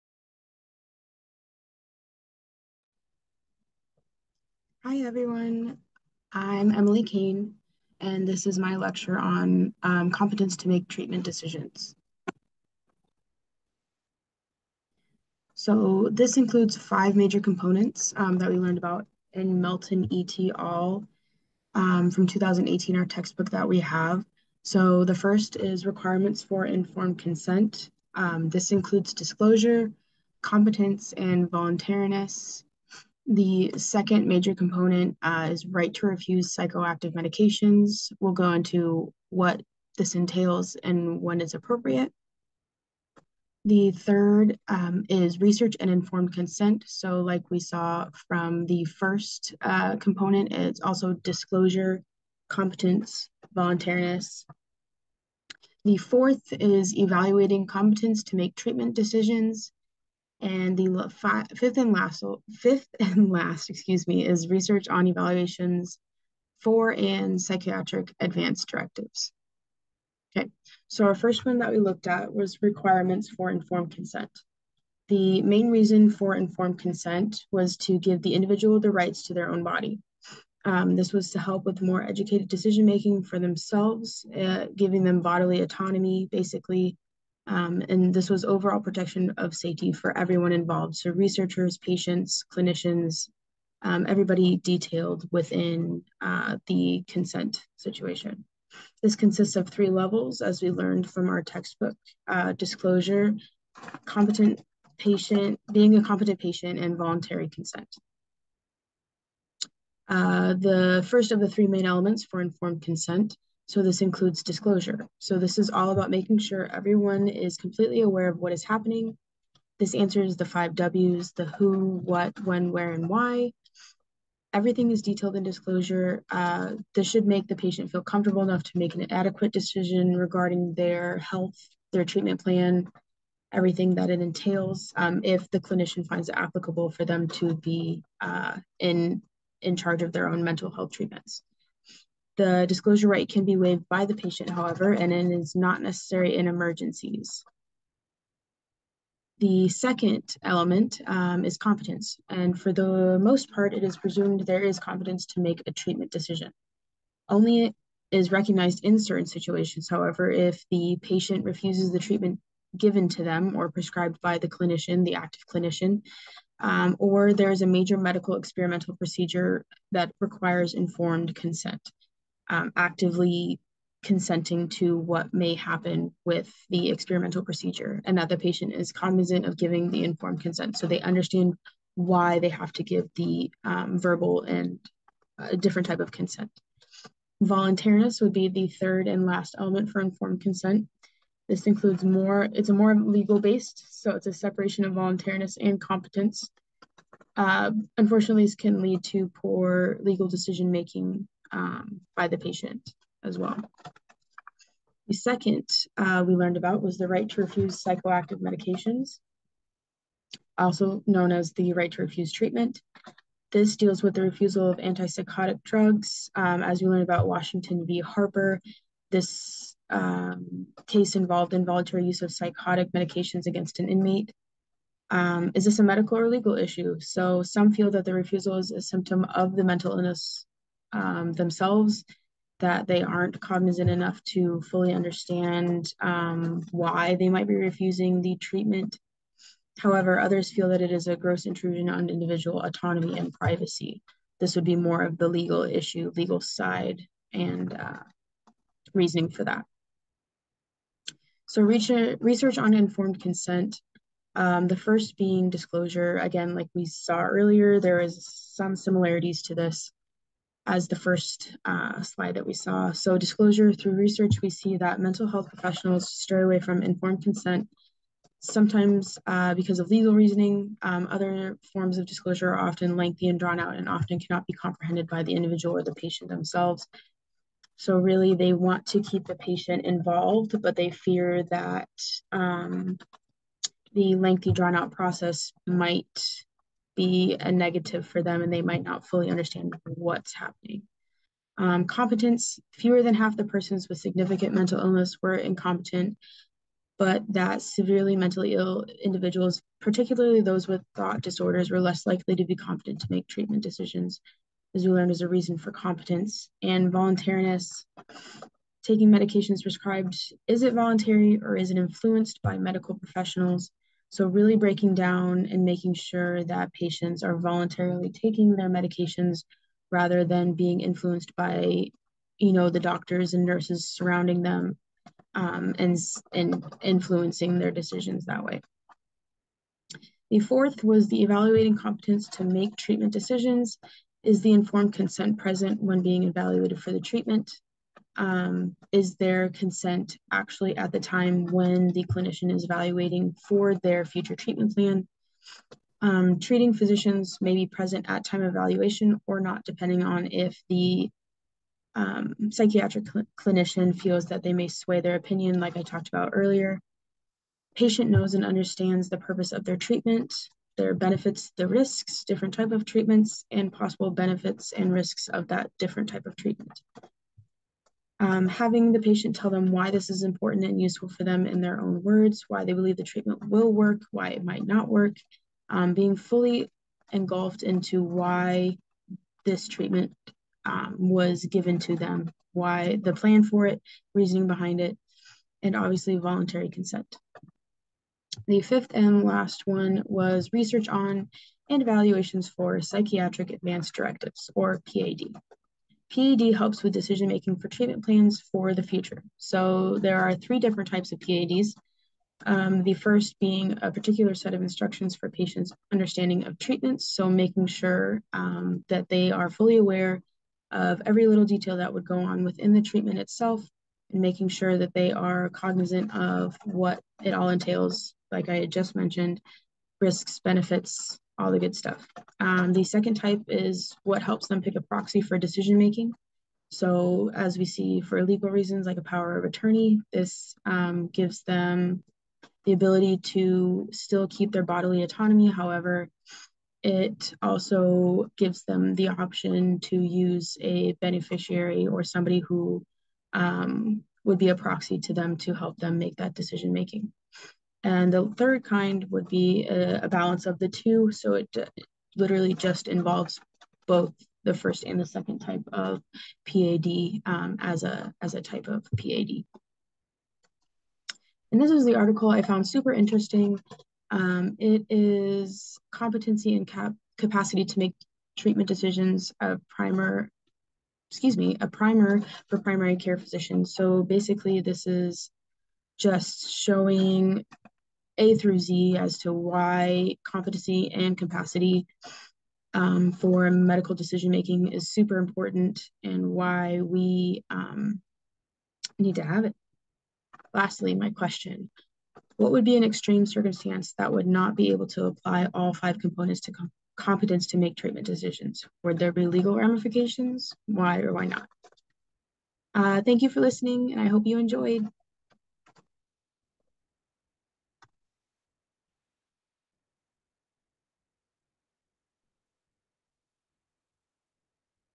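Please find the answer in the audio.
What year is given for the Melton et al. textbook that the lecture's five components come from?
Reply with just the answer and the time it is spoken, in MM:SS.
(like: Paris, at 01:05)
2018, at 00:22.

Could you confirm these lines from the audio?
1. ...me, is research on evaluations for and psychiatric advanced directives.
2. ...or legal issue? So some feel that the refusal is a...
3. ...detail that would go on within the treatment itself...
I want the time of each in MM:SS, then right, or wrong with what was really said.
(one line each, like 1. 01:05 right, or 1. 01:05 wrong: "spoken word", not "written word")
1. 01:04 right
2. 03:46 right
3. 06:51 right.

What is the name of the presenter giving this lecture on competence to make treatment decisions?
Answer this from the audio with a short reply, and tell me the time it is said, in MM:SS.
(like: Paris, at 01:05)
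Emily Cain, at 00:06.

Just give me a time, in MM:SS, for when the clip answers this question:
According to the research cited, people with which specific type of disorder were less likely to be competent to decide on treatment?
05:00.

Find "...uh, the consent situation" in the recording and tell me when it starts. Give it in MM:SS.
01:36.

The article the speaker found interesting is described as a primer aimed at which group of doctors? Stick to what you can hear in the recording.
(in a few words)
Primary care physicians.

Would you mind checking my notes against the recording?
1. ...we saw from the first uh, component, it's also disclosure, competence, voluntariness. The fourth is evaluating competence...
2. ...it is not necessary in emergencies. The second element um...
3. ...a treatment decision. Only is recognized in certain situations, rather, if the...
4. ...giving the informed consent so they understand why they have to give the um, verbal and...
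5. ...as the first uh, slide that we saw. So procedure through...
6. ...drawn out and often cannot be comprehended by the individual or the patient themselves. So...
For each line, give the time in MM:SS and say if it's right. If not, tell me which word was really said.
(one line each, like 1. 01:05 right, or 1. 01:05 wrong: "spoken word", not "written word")
1. 00:47 right
2. 02:25 right
3. 02:35 wrong: "however", not "rather"
4. 02:59 right
5. 04:20 wrong: "disclosure", not "procedure"
6. 04:33 right.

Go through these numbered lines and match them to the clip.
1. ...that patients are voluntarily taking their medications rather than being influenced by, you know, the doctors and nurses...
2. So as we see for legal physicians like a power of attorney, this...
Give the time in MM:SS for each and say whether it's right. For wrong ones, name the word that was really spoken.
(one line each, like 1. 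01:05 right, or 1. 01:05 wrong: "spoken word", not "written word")
1. 05:16 right
2. 07:06 wrong: "reasons", not "physicians".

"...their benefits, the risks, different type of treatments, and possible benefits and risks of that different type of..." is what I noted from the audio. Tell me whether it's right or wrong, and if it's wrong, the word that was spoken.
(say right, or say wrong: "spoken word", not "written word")
right.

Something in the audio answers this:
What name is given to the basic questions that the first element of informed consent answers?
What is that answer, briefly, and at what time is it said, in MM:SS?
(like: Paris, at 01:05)
The five W's, at 02:00.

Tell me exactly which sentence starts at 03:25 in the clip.
The second uh, we learned about was the right to refuse psychoactive medications, also known as the right to refuse treatment.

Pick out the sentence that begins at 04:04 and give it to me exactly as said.
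This would be more of the legal issue, legal side, and uh, reasoning for that.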